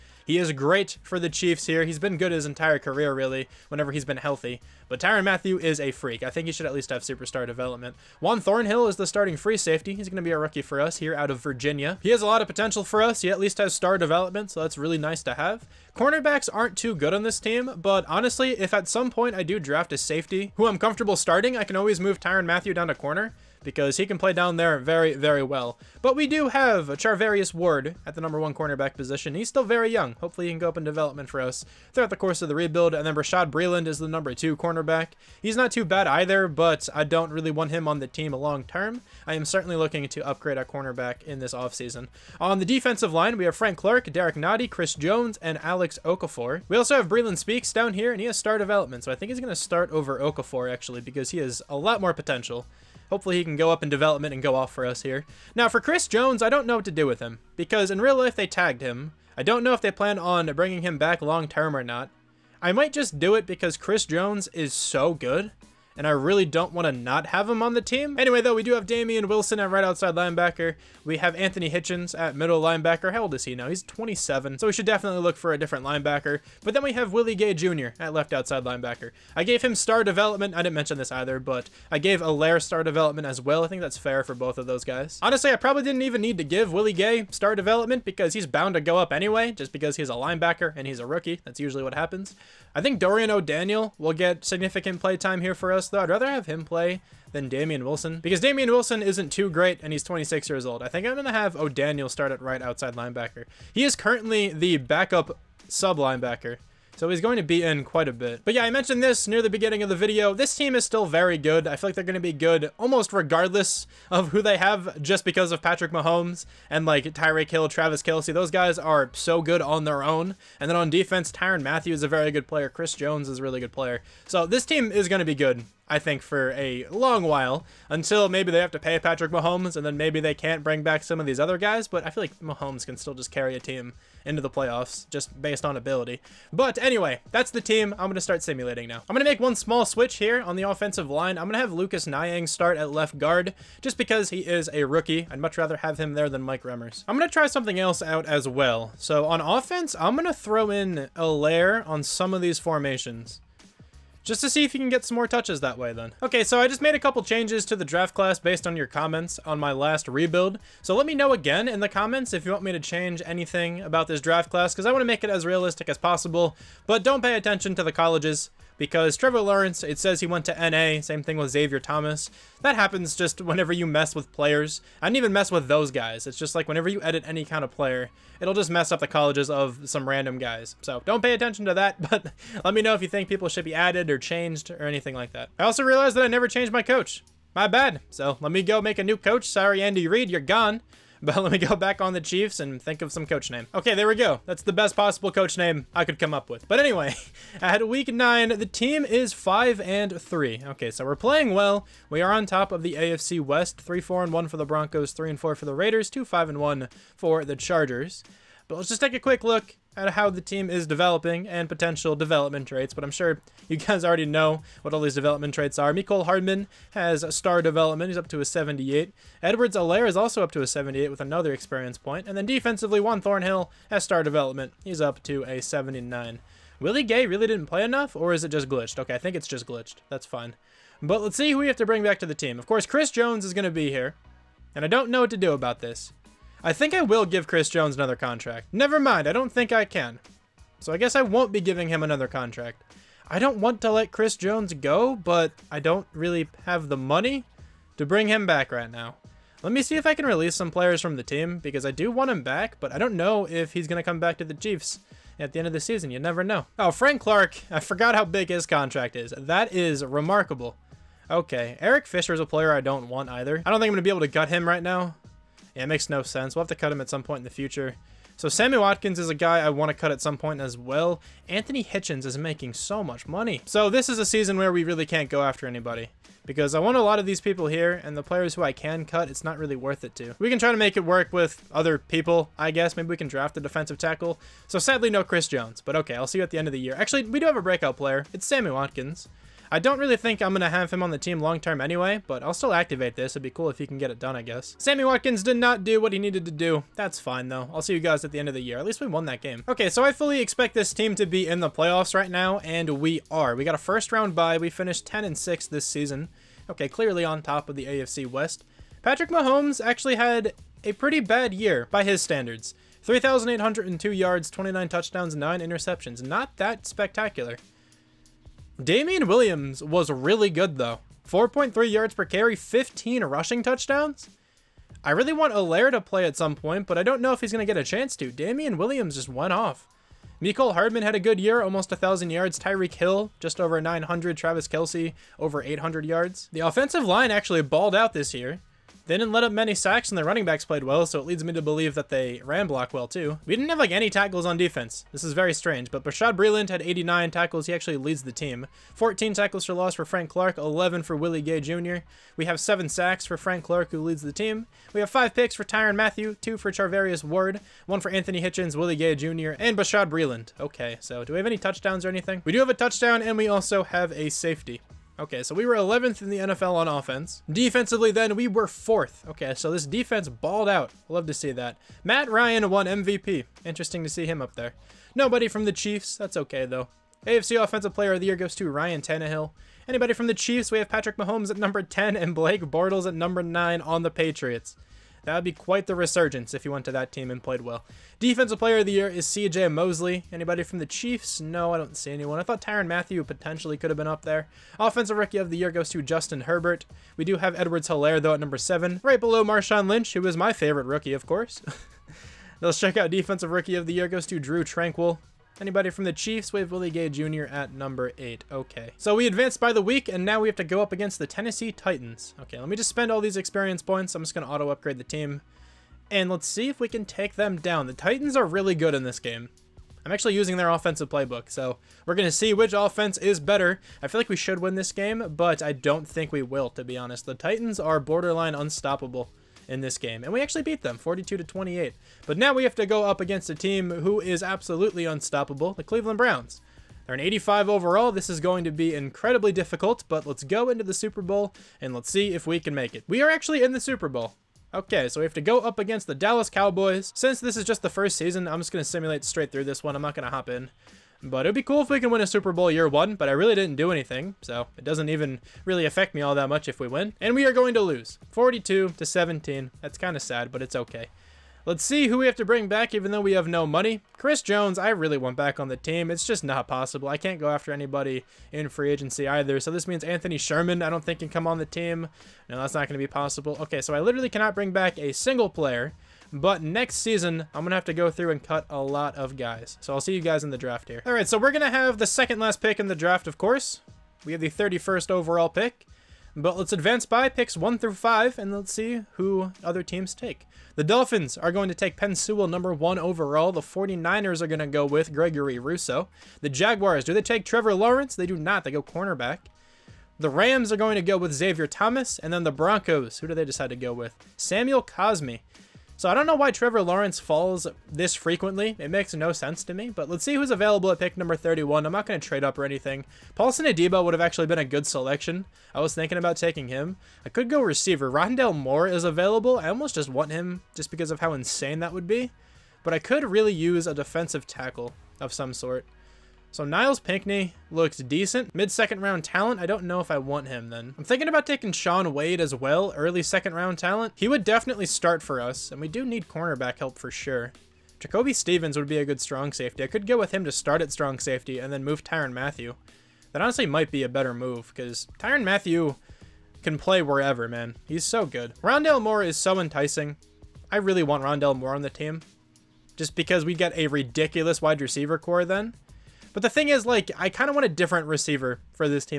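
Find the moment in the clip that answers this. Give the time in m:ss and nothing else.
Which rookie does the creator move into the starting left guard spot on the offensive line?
2:21.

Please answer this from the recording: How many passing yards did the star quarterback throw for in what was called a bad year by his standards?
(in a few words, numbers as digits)
3,802.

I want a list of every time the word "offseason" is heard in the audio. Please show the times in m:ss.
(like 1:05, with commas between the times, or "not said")
0:41.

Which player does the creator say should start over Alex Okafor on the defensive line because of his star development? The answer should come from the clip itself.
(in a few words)
Breeland Speaks.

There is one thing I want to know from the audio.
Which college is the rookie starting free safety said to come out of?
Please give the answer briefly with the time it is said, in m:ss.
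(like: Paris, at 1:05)
Virginia, at 0:11.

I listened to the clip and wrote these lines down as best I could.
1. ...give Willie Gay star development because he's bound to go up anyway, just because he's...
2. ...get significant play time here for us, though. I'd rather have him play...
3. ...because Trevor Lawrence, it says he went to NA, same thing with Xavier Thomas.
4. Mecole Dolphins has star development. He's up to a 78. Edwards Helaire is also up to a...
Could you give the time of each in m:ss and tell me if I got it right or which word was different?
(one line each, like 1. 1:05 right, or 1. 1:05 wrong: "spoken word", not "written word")
1. 1:26 right
2. 1:34 right
3. 2:48 right
4. 3:35 wrong: "Hardman", not "Dolphins".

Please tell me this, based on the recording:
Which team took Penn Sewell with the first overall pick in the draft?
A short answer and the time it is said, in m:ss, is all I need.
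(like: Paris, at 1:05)
Dolphins, at 8:10.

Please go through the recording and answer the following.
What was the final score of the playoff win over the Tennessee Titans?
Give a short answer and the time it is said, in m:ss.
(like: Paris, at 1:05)
42-28, at 7:10.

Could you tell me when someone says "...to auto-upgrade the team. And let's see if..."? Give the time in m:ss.
6:54.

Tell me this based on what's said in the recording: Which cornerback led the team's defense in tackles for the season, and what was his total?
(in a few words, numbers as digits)
Bashaud Breeland, 89.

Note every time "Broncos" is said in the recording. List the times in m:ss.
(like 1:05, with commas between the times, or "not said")
3:24, 8:22.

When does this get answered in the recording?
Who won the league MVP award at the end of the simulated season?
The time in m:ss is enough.
6:12.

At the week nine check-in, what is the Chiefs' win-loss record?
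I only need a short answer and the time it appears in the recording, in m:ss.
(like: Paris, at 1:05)
5-3, at 3:19.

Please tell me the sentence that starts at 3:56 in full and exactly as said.
I think I will give Chris Jones another contract.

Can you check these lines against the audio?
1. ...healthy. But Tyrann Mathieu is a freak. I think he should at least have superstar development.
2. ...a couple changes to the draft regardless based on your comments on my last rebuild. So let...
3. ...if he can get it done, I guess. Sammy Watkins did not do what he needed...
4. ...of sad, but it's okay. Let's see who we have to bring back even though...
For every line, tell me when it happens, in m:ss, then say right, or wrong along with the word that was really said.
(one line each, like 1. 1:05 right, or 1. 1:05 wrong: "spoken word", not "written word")
1. 0:04 right
2. 2:36 wrong: "class", not "regardless"
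3. 4:53 right
4. 7:40 right.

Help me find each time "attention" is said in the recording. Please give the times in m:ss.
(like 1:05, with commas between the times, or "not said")
2:47, 3:01.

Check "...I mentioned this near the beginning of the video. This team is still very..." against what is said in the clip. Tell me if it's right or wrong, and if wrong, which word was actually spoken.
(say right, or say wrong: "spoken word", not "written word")
right.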